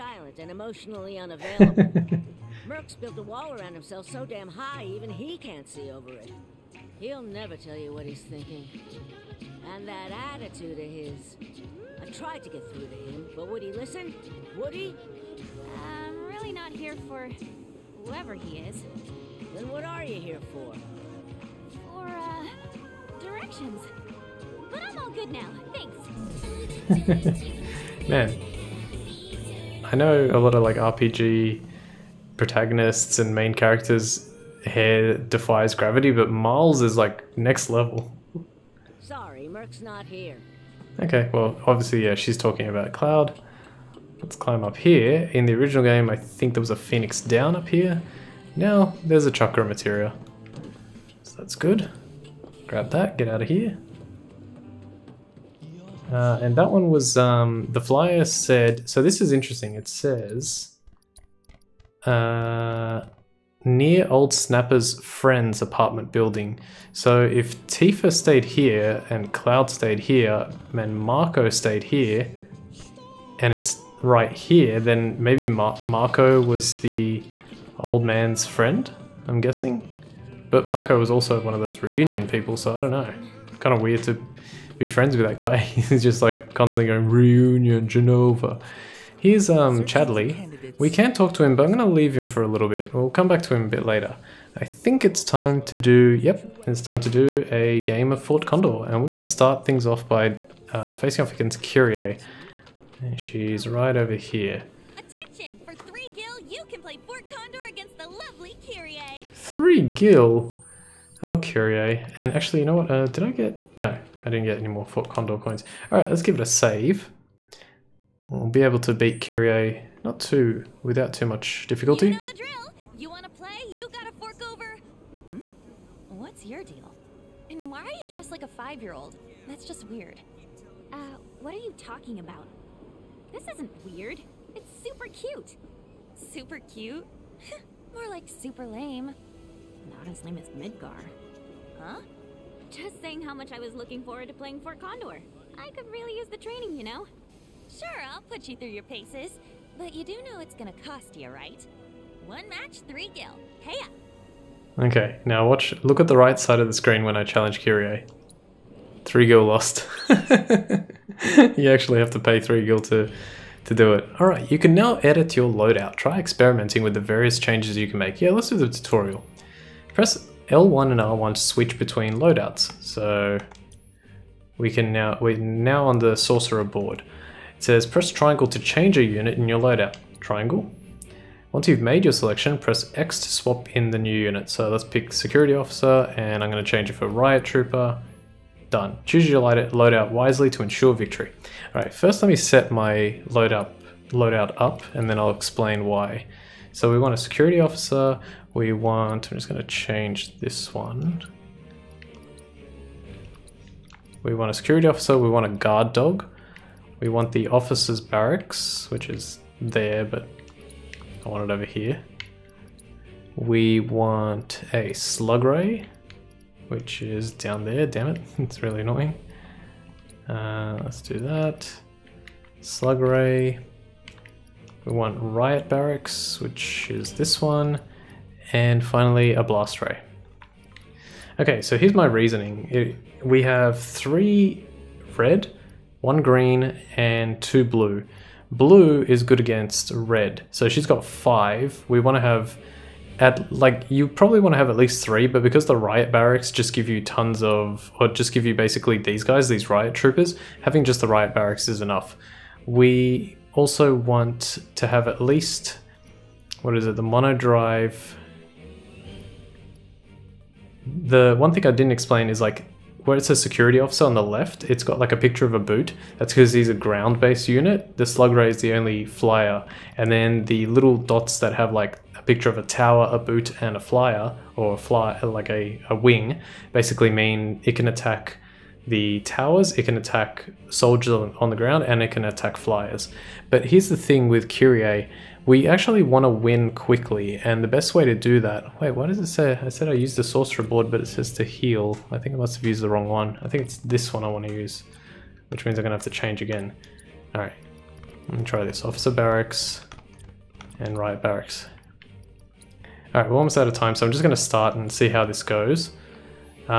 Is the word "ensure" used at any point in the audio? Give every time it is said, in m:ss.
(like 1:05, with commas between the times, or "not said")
3:10.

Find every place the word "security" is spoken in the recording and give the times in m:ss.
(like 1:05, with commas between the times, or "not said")
3:05, 3:17, 3:24, 4:23.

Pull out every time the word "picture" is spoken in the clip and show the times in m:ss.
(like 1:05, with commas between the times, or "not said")
4:25, 4:32.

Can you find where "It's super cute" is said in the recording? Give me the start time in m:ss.
2:14.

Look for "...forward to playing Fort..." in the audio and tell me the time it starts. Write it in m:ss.
2:24.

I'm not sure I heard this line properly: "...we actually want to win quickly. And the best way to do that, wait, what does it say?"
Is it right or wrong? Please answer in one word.
right.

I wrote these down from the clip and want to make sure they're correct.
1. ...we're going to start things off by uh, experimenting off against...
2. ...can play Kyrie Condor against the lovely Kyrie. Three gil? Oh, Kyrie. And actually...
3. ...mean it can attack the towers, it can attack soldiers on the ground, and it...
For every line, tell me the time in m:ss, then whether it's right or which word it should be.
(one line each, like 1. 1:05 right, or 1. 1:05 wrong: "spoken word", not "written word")
1. 1:38 wrong: "facing", not "experimenting"
2. 1:46 wrong: "Fort", not "Kyrie"
3. 4:37 right.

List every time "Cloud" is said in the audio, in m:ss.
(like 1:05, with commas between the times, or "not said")
0:42, 1:09.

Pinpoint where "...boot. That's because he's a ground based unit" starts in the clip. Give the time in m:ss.
4:25.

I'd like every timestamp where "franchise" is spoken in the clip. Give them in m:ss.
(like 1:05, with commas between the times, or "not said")
not said.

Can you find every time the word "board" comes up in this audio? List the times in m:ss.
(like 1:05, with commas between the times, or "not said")
2:56, 4:50.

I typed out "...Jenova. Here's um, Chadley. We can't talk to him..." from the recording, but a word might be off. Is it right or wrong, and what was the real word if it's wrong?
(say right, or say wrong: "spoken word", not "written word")
right.